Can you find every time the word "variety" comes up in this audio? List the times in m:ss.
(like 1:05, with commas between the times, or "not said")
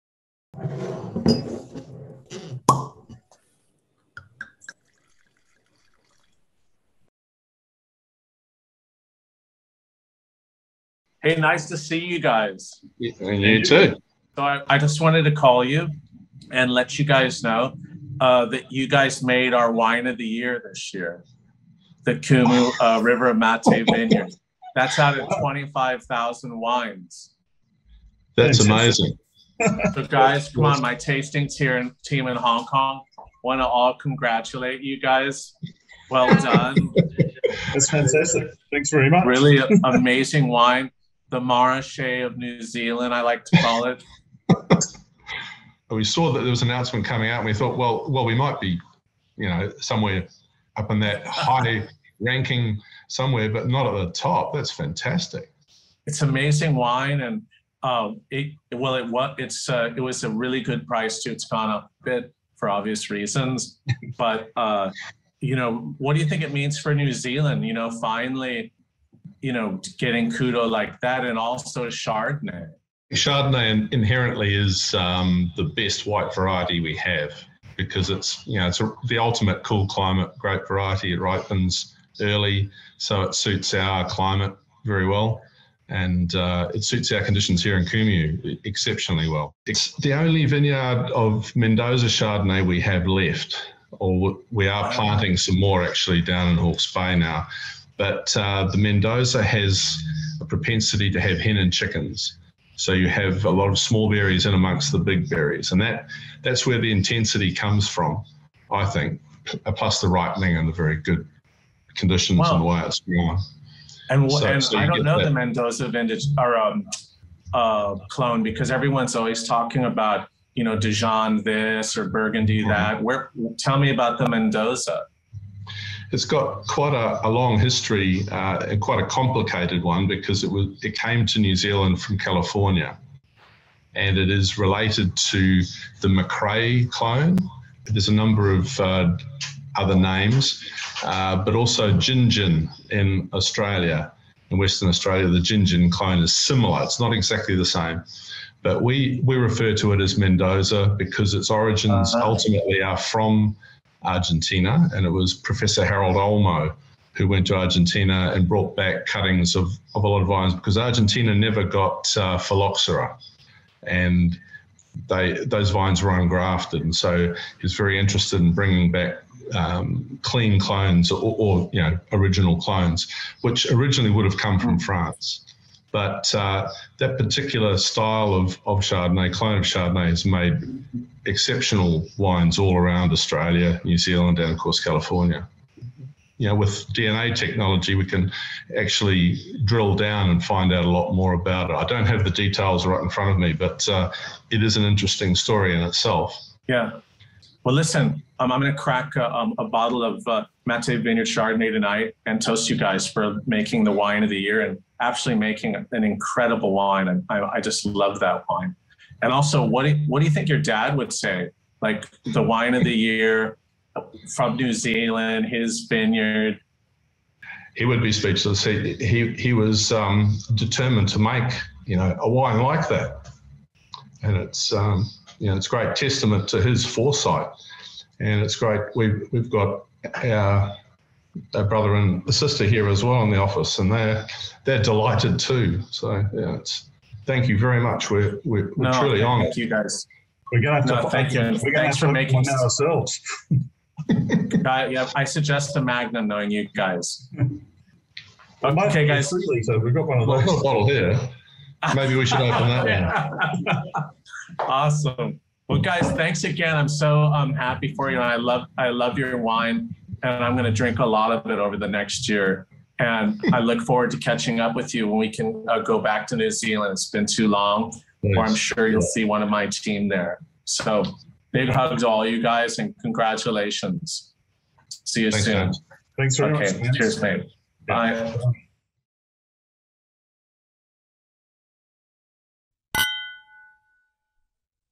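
1:16, 1:20.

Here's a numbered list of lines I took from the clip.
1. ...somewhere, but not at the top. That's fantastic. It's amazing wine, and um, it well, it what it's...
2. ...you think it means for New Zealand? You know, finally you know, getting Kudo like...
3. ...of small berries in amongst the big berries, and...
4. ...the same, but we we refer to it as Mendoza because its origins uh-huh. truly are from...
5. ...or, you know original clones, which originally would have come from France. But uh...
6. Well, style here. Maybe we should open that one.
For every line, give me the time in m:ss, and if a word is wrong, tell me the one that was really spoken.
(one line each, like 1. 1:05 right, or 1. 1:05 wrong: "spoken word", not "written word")
1. 0:53 right
2. 1:06 right
3. 1:43 right
4. 2:27 wrong: "ultimately", not "truly"
5. 2:51 right
6. 4:10 wrong: "bottle", not "style".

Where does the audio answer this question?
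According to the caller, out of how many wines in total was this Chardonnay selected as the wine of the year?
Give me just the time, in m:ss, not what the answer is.
0:25.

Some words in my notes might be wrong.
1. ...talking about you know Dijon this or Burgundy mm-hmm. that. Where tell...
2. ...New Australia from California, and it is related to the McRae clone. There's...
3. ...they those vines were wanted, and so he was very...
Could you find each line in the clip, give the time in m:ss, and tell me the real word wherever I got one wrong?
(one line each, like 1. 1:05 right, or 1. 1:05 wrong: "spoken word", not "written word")
1. 1:59 right
2. 2:11 wrong: "Zealand", not "Australia"
3. 2:45 wrong: "ungrafted", not "wanted".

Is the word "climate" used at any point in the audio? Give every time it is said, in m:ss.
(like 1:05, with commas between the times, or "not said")
1:19, 1:24.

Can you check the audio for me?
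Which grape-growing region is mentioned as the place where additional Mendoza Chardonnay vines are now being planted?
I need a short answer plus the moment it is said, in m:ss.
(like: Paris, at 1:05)
Hawke's Bay, at 1:36.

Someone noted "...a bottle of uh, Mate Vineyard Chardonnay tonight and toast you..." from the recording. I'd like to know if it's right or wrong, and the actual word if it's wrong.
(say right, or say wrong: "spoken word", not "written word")
right.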